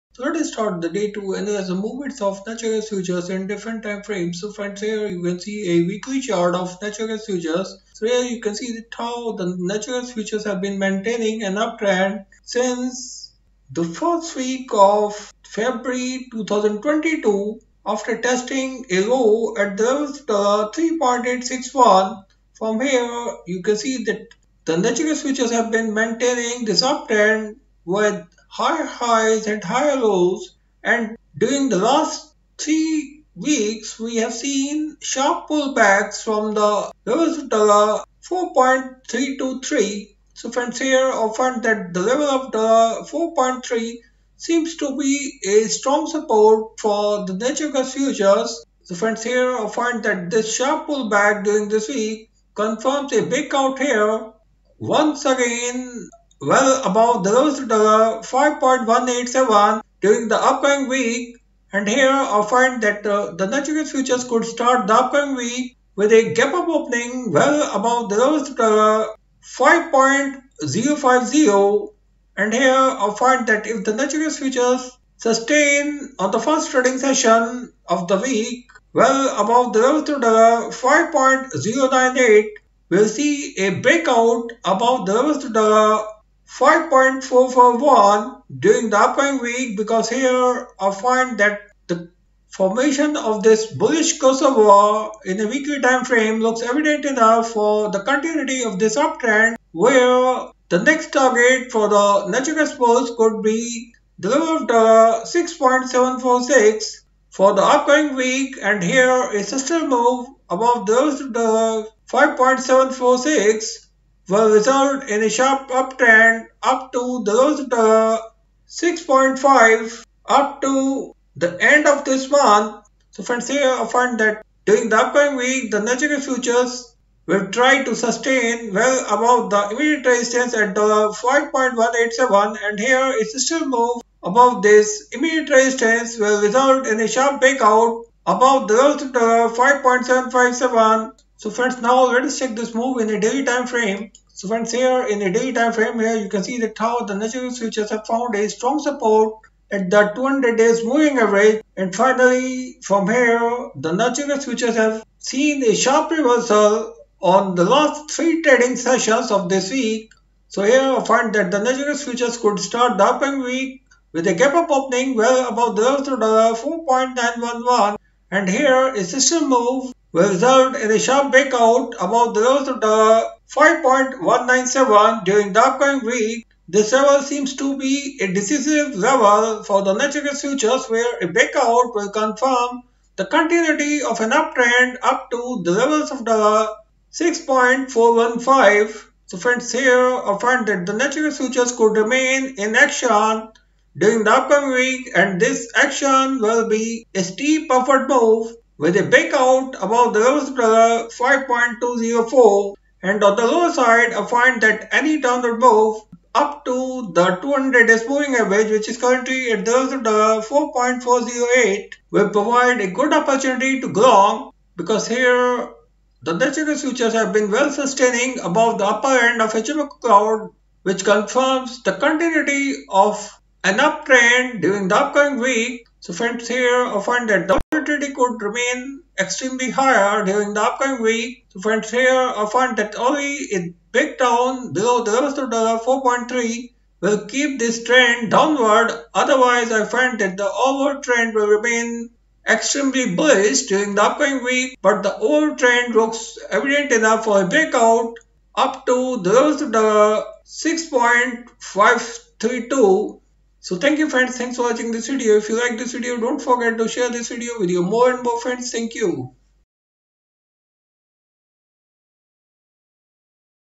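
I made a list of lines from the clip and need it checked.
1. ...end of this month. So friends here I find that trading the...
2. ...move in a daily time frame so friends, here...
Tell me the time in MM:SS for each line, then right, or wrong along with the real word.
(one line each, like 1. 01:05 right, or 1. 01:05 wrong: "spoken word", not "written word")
1. 02:01 wrong: "during", not "trading"
2. 02:22 right.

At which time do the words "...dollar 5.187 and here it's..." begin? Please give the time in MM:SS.
02:10.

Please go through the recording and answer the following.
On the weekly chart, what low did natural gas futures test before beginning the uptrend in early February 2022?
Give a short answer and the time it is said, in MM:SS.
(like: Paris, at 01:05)
3.861, at 00:20.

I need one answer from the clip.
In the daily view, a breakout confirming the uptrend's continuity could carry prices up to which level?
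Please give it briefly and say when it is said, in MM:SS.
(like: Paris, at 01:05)
6.415, at 03:07.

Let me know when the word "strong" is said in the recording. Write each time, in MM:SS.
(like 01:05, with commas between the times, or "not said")
00:45, 02:28.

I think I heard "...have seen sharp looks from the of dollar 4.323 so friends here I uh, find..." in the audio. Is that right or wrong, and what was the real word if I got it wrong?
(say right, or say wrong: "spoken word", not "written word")
wrong: "pullbacks", not "looks".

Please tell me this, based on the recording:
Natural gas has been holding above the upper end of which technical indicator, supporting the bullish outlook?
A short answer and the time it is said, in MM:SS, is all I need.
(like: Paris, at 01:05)
HMO cloud, at 03:39.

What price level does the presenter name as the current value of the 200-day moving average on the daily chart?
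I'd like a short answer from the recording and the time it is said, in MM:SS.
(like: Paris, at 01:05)
4.408, at 03:30.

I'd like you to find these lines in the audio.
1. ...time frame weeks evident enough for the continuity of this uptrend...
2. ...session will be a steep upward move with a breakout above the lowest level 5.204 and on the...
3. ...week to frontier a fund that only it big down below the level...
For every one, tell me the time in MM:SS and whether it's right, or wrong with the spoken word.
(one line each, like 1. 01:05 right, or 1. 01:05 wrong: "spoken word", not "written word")
1. 01:35 wrong: "looks", not "weeks"
2. 03:15 wrong: "action", not "session"
3. 03:51 right.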